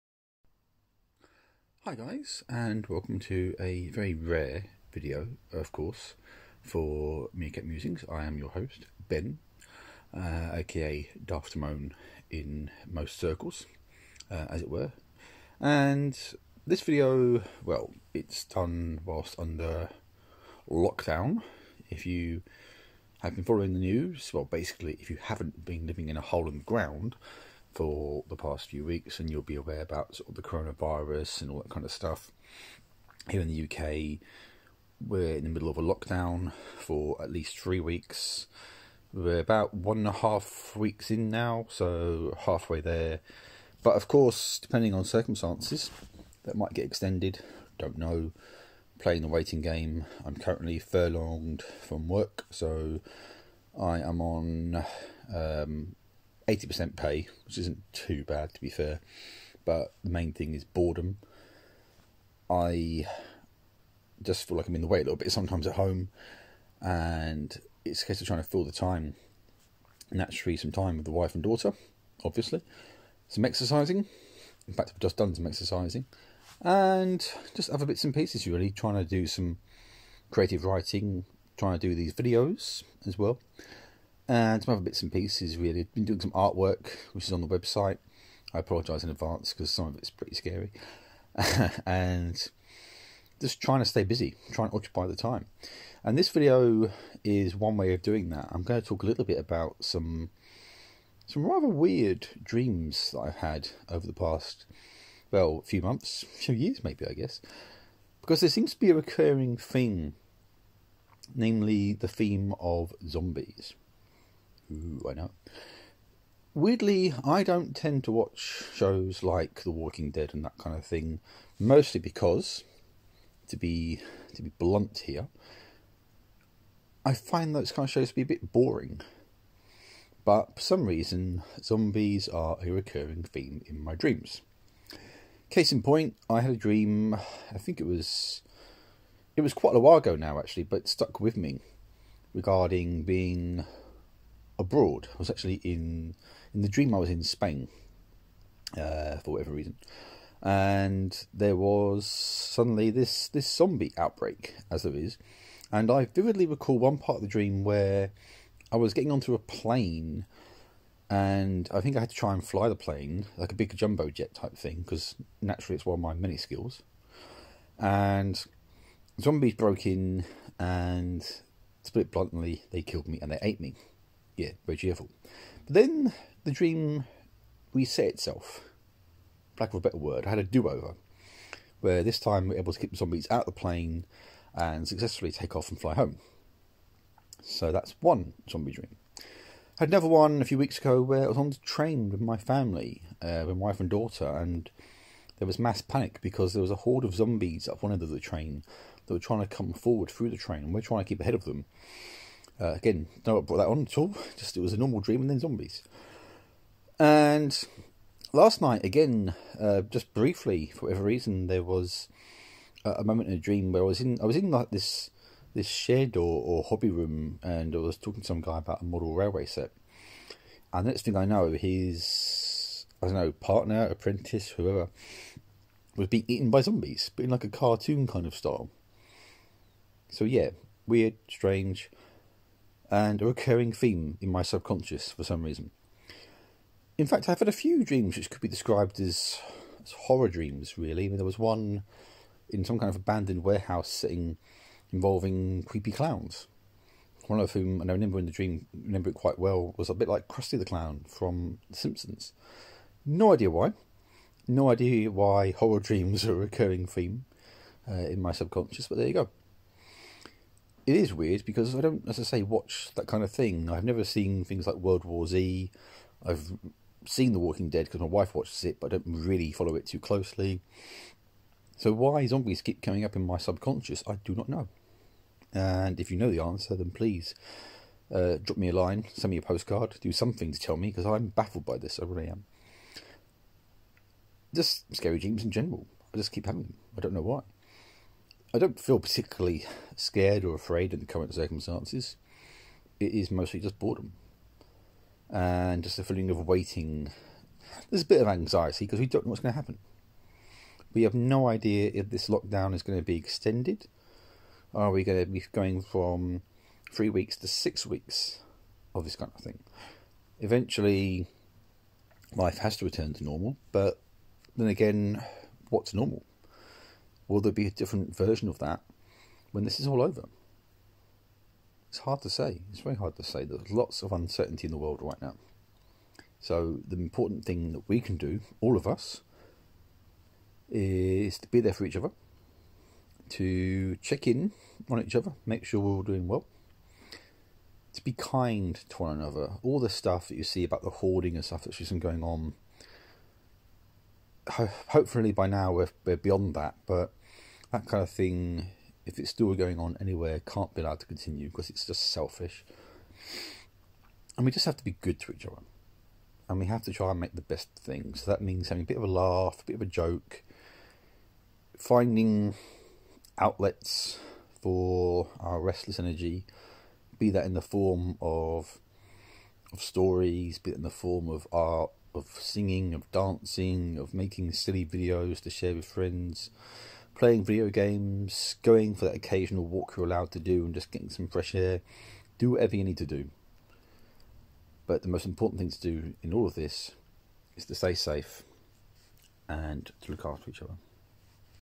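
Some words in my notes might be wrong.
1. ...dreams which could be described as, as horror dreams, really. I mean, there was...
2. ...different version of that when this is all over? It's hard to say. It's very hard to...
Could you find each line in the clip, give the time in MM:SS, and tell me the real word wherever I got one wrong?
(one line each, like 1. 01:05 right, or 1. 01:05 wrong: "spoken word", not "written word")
1. 03:57 right
2. 05:17 right.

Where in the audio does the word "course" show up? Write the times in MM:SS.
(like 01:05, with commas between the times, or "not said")
00:05, 00:44.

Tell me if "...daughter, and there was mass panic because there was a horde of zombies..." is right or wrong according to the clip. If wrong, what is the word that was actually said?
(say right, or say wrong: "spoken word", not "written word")
right.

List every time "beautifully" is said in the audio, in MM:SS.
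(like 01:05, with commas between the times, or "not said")
not said.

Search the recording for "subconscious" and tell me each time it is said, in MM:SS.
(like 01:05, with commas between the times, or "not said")
03:54, 04:18, 04:33.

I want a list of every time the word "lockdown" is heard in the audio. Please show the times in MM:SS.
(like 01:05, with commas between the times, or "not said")
00:20, 00:35, 05:02.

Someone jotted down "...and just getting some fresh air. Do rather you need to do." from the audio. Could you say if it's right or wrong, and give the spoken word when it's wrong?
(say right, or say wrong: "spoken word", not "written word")
wrong: "whatever", not "rather".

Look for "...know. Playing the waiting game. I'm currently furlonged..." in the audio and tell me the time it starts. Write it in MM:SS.
00:47.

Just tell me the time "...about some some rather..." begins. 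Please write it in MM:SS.
01:39.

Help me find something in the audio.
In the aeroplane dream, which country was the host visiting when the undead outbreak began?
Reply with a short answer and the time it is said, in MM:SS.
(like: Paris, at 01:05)
Spain, at 02:27.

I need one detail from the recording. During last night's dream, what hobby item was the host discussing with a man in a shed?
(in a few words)
Model railway set.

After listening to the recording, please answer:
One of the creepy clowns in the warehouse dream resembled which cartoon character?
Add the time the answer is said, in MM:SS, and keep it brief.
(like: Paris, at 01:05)
Krusty the Clown, at 04:10.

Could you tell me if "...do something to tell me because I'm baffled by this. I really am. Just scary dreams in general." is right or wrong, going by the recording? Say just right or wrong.
right.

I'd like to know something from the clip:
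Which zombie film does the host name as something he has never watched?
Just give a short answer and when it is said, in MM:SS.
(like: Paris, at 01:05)
World War Z, at 04:24.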